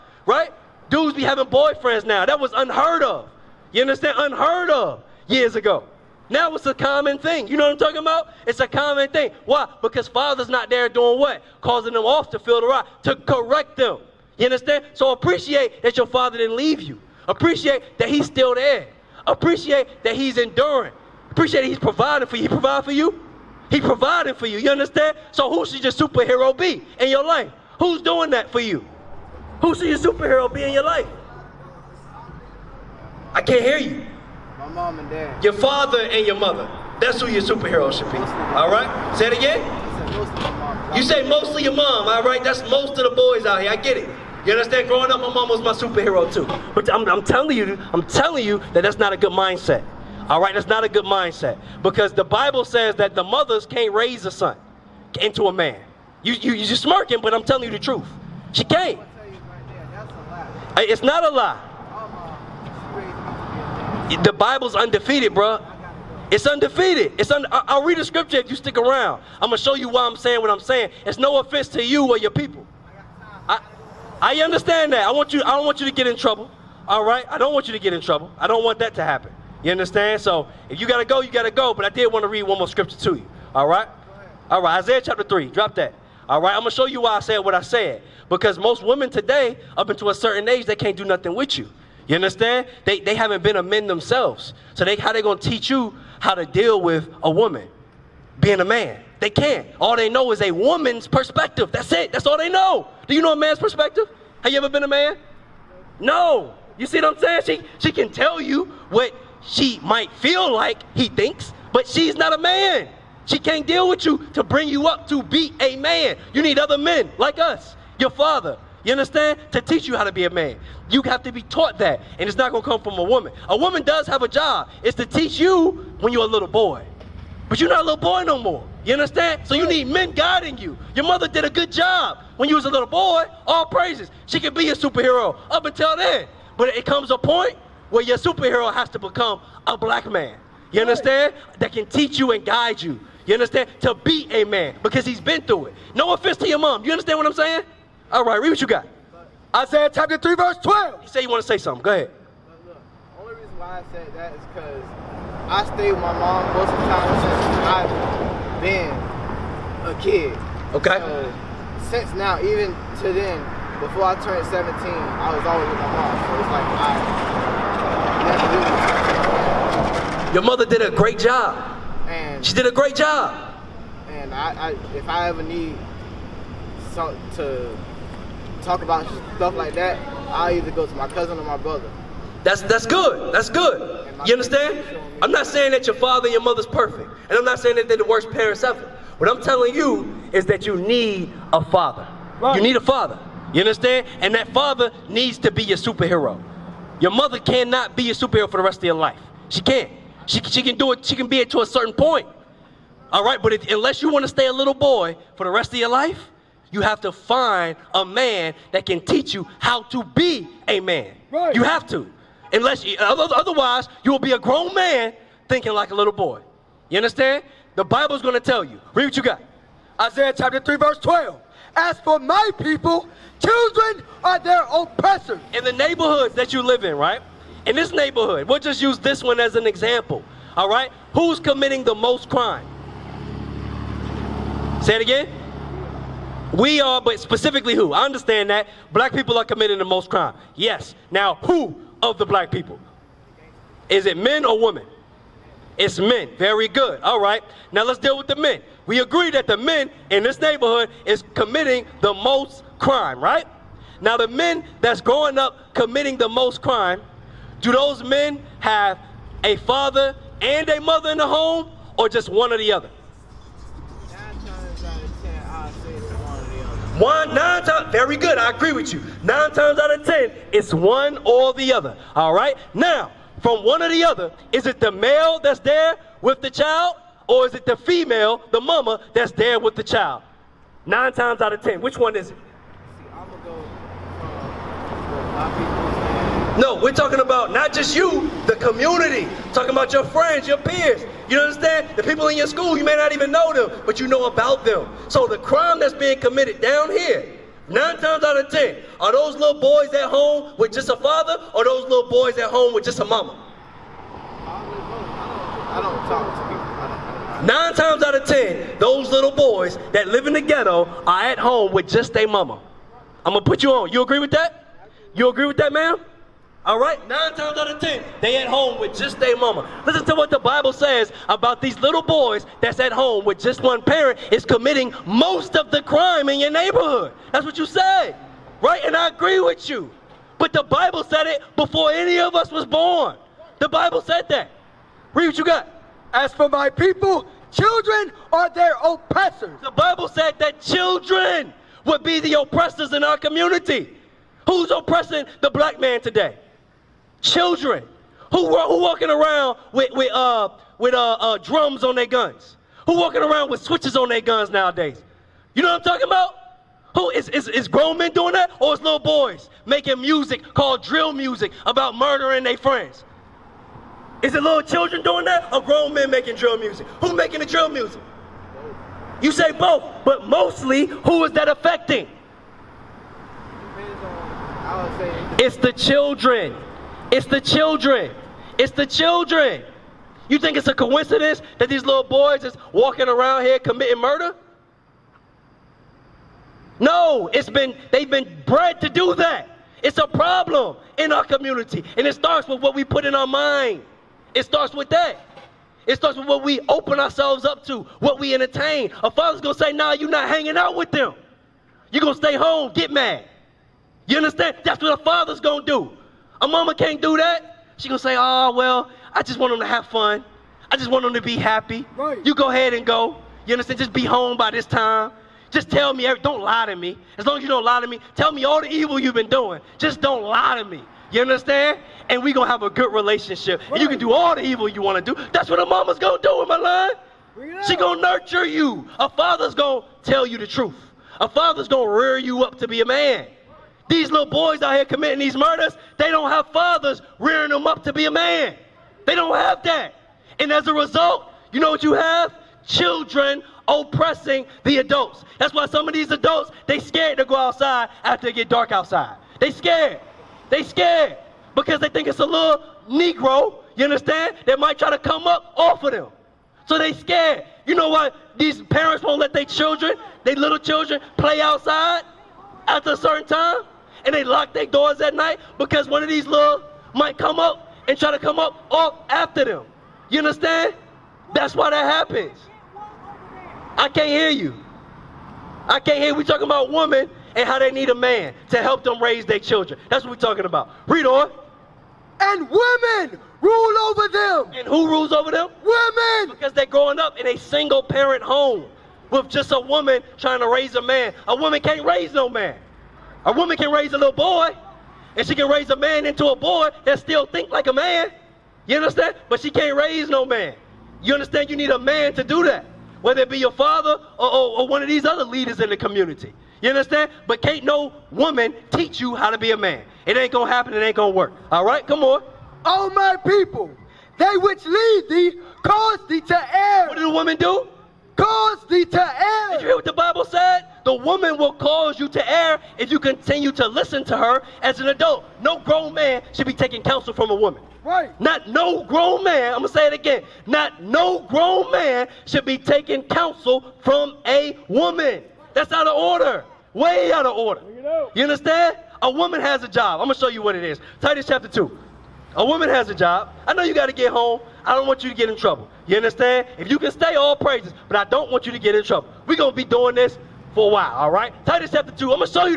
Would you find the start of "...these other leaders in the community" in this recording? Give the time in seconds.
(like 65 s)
504 s.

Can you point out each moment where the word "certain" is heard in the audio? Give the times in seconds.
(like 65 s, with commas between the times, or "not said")
90 s, 201 s, 462 s.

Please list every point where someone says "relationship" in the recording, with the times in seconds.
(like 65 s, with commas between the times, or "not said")
422 s.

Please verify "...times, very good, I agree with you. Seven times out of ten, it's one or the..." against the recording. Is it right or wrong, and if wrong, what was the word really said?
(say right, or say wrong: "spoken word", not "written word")
wrong: "Nine", not "Seven".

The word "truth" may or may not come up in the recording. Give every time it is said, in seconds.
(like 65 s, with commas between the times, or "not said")
57 s, 430 s.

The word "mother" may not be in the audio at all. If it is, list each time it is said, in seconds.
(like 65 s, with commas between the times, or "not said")
36 s, 53 s, 131 s, 170 s, 186 s, 197 s, 260 s.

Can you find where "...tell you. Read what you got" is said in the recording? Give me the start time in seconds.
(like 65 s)
218 s.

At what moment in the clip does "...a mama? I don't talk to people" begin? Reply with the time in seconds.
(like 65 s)
302 s.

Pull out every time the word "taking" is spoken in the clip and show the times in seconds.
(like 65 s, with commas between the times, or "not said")
526 s, 532 s.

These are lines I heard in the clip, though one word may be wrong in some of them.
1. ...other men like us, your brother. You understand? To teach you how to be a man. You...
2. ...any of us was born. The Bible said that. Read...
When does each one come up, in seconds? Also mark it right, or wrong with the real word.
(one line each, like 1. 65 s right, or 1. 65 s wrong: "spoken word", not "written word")
1. 116 s wrong: "father", not "brother"
2. 331 s right.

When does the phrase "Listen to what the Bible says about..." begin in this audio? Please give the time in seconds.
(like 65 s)
319 s.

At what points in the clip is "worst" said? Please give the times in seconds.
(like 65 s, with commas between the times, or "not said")
188 s.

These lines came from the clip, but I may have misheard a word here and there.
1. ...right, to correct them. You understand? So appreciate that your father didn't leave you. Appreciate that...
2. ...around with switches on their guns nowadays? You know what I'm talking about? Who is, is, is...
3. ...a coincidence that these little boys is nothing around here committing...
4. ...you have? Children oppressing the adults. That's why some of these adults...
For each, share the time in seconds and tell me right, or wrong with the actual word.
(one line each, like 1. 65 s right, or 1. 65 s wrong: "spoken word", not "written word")
1. 12 s right
2. 353 s right
3. 380 s wrong: "walking", not "nothing"
4. 441 s right.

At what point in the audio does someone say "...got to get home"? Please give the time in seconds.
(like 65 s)
543 s.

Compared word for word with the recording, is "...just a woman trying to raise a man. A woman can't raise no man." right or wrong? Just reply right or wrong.
right.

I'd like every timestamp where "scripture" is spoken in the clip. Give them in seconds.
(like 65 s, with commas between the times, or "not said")
68 s, 82 s.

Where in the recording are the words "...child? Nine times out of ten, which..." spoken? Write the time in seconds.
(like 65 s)
279 s.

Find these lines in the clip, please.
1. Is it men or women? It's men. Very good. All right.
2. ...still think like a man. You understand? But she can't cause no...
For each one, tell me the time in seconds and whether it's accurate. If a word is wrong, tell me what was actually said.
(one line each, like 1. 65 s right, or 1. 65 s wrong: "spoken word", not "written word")
1. 243 s right
2. 496 s wrong: "raise", not "cause".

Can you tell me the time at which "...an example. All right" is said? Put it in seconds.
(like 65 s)
229 s.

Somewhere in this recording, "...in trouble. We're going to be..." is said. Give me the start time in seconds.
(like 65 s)
548 s.